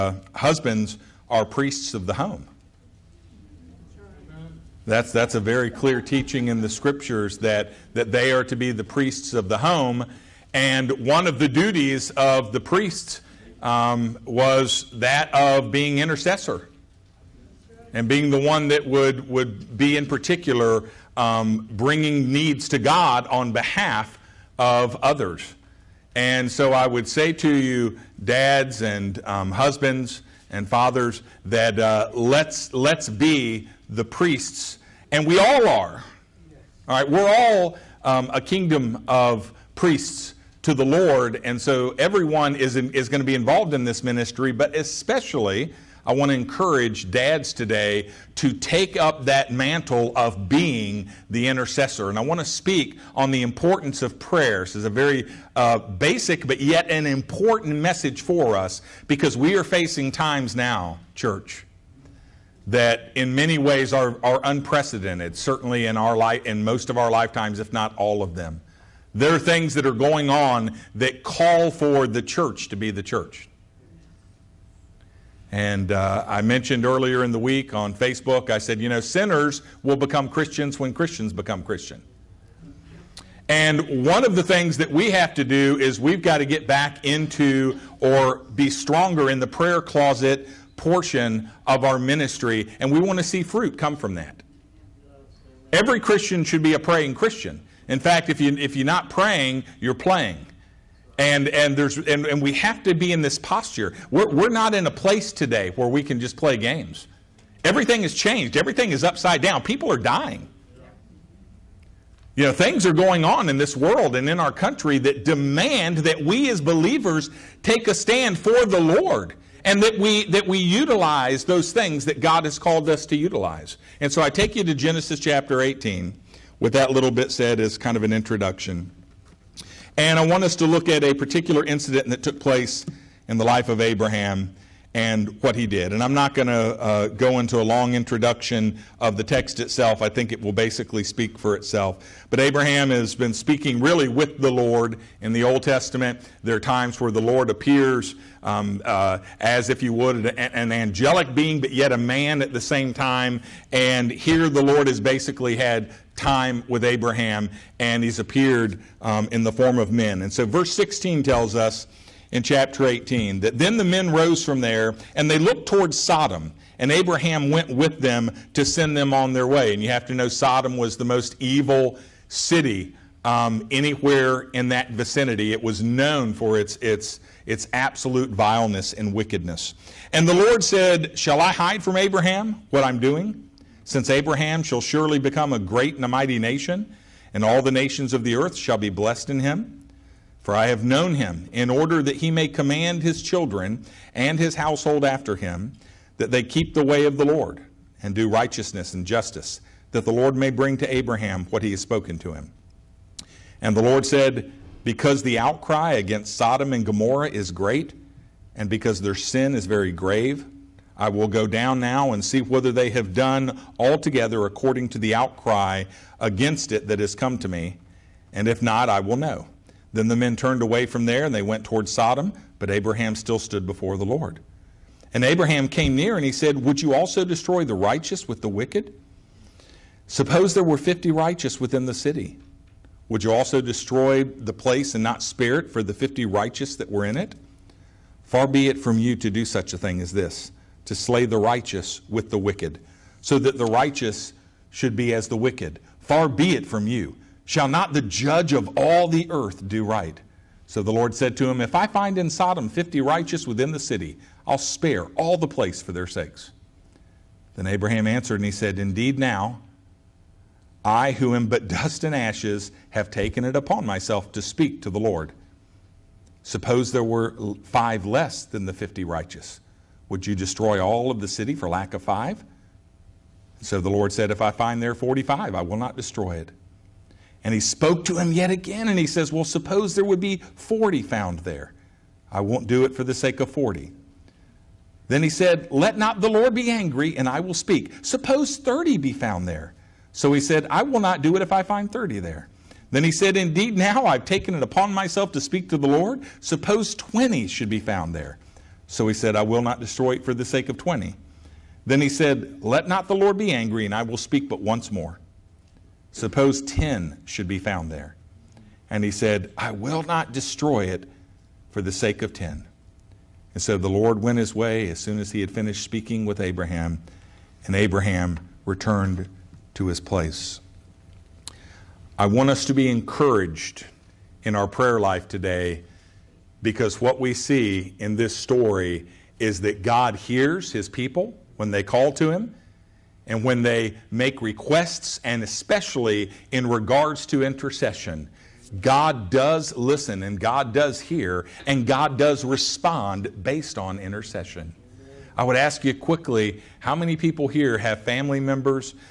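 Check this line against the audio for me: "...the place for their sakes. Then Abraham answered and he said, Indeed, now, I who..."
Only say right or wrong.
right.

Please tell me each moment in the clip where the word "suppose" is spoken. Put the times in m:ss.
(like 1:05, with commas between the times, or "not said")
3:50, 4:26, 4:39, 4:48, 4:56, 5:06.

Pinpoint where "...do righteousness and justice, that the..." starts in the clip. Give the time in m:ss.
3:18.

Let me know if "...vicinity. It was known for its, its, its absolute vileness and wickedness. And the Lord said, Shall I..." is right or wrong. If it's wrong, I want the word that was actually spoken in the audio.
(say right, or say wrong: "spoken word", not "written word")
right.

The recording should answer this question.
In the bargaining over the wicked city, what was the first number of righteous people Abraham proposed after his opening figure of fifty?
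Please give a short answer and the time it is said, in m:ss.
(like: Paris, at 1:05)
45, at 4:34.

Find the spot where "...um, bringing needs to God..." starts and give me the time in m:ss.
0:21.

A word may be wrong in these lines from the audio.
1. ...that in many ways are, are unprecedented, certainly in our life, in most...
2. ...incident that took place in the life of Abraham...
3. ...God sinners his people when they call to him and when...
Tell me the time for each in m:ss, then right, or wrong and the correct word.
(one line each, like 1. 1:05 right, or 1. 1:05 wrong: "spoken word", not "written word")
1. 1:02 right
2. 2:11 right
3. 5:29 wrong: "hears", not "sinners".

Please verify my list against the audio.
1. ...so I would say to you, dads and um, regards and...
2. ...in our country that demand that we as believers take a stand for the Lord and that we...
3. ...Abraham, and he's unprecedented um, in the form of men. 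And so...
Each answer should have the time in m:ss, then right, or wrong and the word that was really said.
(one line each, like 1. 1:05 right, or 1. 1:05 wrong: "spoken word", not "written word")
1. 0:26 wrong: "husbands", not "regards"
2. 1:54 right
3. 2:36 wrong: "appeared", not "unprecedented".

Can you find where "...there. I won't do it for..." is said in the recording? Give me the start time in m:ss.
4:41.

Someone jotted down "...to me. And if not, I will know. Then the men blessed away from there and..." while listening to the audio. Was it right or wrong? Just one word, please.
wrong.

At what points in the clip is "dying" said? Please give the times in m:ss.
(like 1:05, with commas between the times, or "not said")
1:49.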